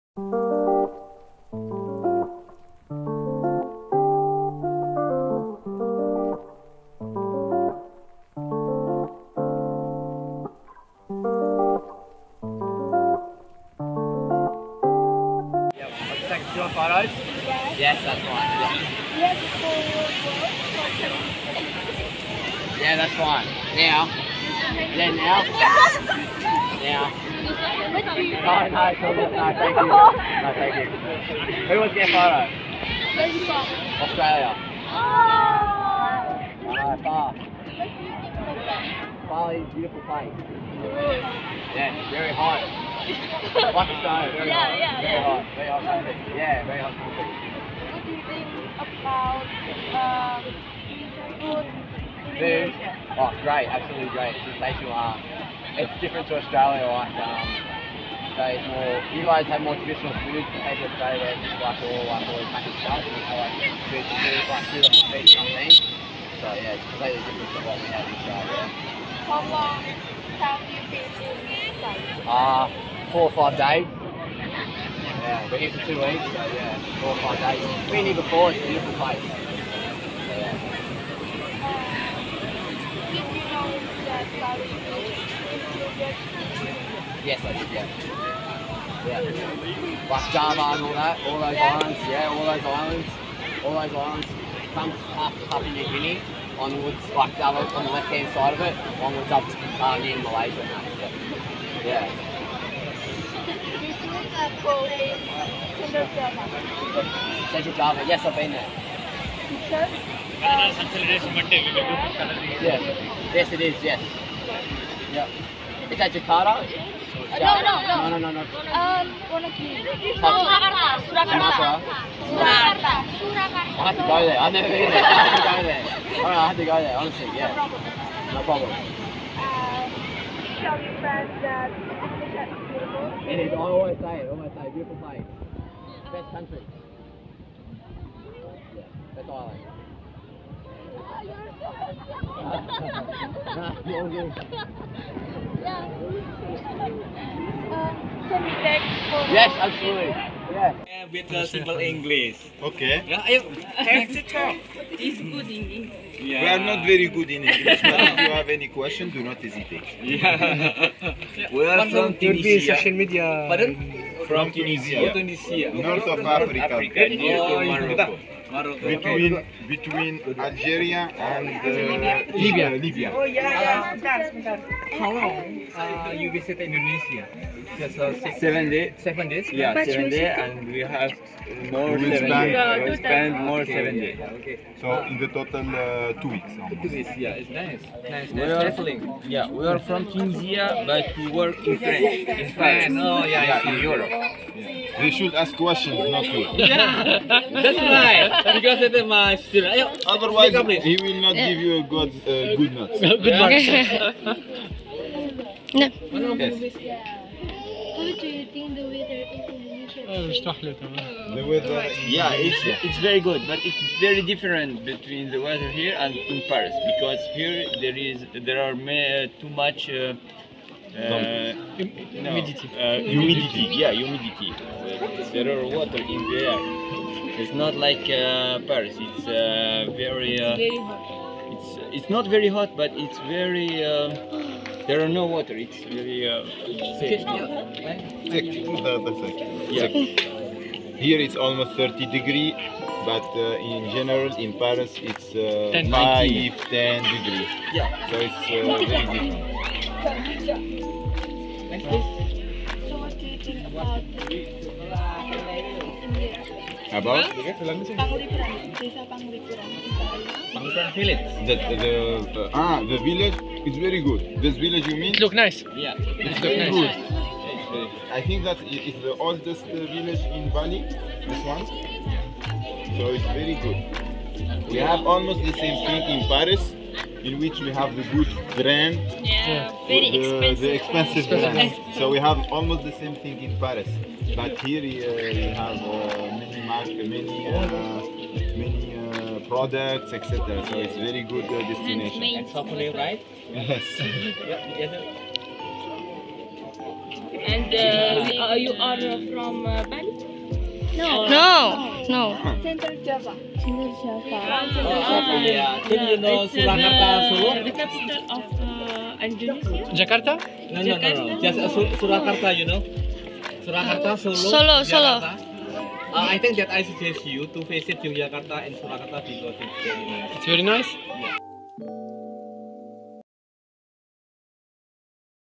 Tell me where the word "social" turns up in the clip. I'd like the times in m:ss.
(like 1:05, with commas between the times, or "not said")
2:42.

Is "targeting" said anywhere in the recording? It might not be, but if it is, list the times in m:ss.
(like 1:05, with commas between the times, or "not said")
not said.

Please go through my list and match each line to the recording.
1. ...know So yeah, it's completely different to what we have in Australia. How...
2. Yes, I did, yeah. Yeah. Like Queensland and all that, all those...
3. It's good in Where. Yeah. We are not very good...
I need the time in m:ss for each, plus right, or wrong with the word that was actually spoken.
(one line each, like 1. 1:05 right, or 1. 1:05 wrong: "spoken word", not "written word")
1. 1:05 right
2. 1:27 wrong: "Java", not "Queensland"
3. 2:34 wrong: "English", not "Where".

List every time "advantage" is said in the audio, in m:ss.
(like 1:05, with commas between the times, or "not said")
not said.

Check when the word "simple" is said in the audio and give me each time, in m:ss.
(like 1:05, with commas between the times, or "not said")
2:31.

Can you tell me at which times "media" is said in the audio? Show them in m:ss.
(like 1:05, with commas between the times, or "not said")
2:42.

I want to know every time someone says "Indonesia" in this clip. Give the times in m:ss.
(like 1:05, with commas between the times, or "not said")
2:56, 3:29.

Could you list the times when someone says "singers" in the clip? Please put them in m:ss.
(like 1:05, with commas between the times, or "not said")
not said.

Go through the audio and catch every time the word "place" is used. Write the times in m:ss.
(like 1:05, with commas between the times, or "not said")
0:40, 1:18, 2:14.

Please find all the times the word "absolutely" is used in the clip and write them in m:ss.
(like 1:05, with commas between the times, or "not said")
0:53, 2:29.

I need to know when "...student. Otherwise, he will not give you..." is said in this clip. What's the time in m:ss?
3:19.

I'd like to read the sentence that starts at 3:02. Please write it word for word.
We spend more okay, seven days.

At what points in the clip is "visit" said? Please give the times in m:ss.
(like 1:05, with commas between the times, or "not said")
2:56, 5:17.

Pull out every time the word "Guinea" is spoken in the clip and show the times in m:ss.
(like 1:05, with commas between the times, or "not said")
1:35.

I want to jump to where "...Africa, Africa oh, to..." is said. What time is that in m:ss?
2:46.